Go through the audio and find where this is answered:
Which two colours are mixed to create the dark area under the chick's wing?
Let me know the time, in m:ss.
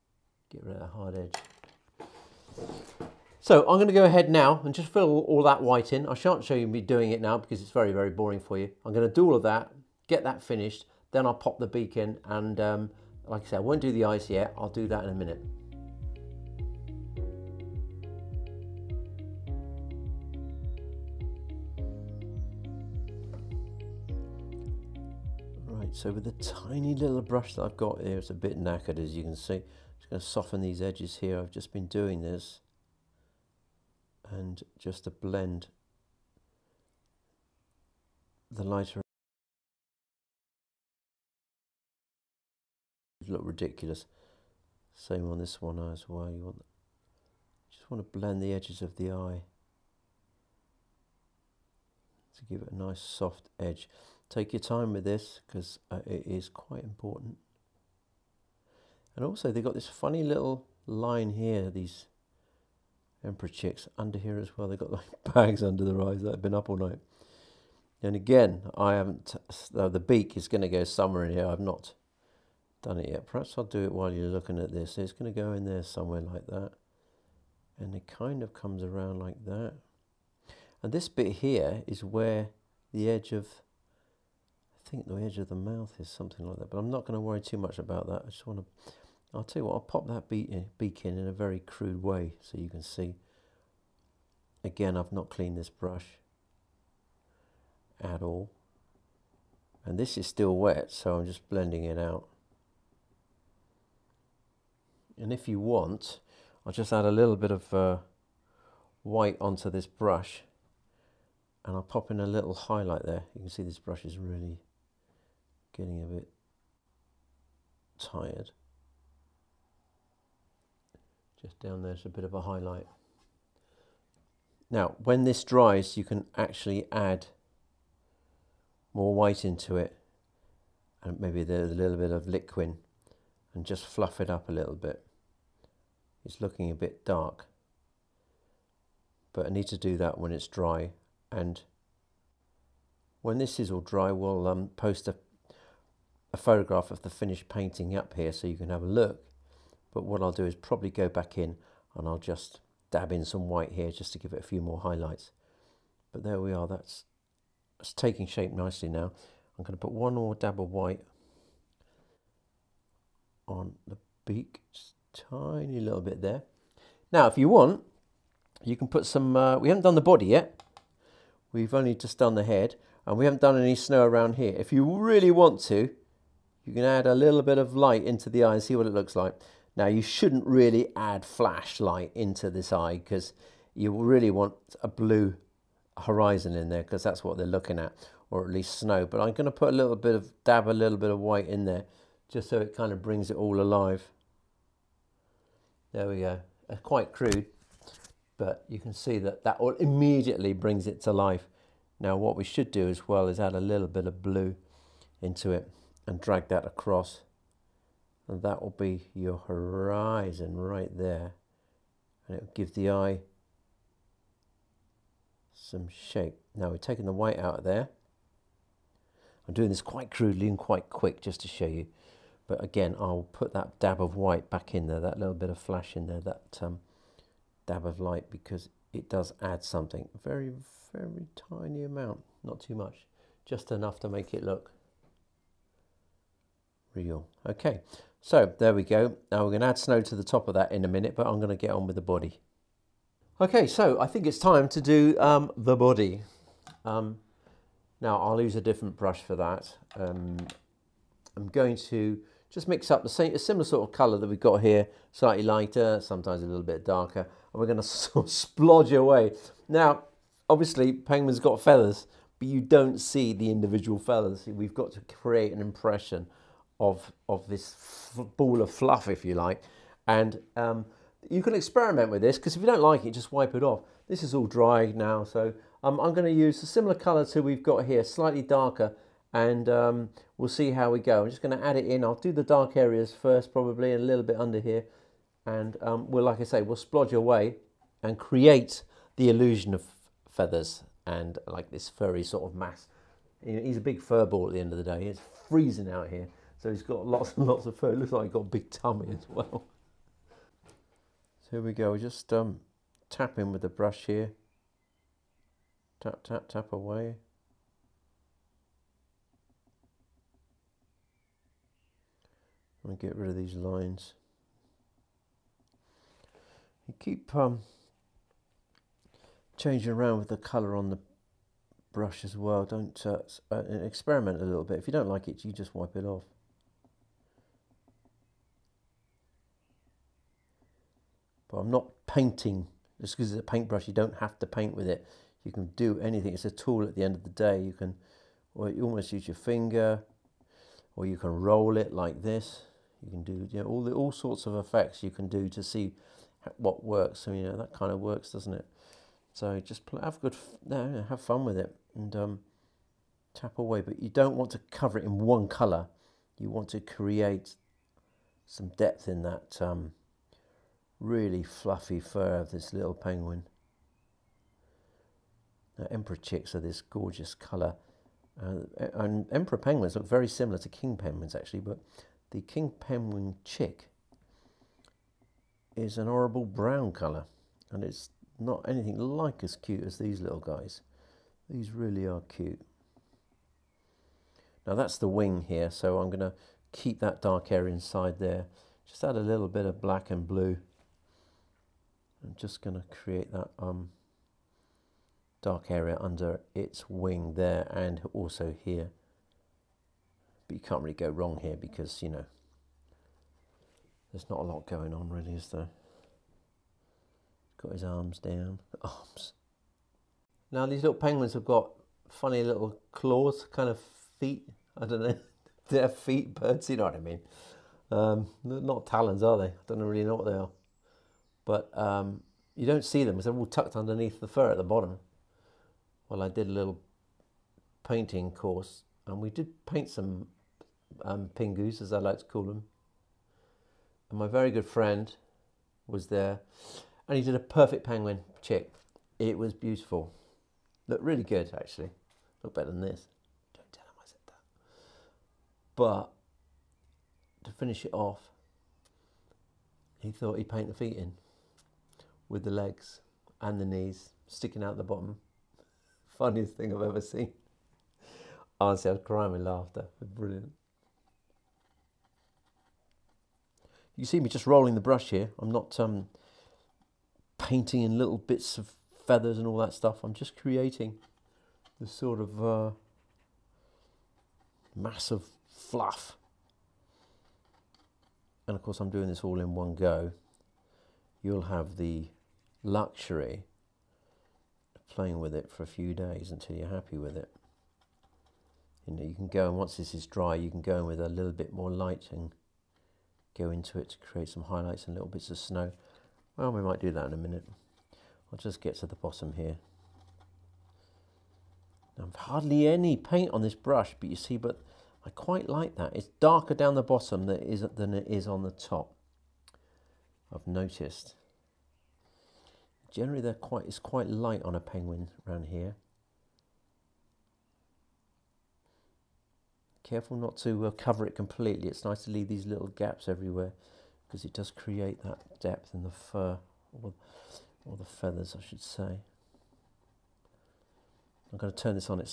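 6:29.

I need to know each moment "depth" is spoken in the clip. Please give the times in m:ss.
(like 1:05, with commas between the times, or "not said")
5:58, 8:45.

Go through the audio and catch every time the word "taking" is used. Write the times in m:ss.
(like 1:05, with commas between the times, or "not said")
2:37, 3:36.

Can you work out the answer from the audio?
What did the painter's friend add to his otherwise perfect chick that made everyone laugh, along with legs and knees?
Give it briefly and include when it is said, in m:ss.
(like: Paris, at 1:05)
the feet, at 7:30.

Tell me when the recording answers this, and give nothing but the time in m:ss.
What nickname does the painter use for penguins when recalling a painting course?
7:11.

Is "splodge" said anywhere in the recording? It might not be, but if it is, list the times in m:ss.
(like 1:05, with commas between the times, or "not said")
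4:18, 4:46.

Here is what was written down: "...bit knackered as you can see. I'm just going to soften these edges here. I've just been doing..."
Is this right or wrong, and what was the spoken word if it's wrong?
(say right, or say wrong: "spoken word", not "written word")
right.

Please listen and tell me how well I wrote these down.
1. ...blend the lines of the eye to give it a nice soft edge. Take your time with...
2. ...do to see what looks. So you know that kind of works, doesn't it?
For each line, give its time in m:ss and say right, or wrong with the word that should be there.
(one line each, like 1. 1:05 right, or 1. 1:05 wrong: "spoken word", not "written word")
1. 0:48 wrong: "edges", not "lines"
2. 5:45 wrong: "works", not "looks".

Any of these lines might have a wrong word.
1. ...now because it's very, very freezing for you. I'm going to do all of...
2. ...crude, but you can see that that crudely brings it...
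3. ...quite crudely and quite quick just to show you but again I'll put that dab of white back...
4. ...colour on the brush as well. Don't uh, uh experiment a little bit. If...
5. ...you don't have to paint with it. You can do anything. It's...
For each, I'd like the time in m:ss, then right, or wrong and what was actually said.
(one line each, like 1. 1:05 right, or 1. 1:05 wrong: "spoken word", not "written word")
1. 0:07 wrong: "boring", not "freezing"
2. 3:17 wrong: "immediately", not "crudely"
3. 3:39 right
4. 5:20 right
5. 5:33 right.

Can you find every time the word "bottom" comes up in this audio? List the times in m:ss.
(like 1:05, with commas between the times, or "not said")
7:04, 7:34, 8:18, 8:26.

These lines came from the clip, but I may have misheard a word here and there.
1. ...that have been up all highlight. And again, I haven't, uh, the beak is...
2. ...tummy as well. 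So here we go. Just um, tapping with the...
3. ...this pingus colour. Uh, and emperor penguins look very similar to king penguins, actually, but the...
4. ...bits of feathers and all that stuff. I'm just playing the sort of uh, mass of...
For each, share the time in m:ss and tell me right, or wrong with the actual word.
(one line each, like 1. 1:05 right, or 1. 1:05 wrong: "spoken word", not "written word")
1. 1:06 wrong: "night", not "highlight"
2. 4:58 right
3. 6:06 wrong: "gorgeous", not "pingus"
4. 7:48 wrong: "creating", not "playing".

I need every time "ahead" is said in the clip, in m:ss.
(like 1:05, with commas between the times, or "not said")
0:04.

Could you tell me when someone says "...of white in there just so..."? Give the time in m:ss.
3:11.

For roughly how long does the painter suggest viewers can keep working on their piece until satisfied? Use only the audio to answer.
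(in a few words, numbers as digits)
a few days.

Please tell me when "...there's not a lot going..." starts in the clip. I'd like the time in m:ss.
6:44.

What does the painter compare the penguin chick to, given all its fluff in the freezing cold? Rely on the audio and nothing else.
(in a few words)
a big fur ball.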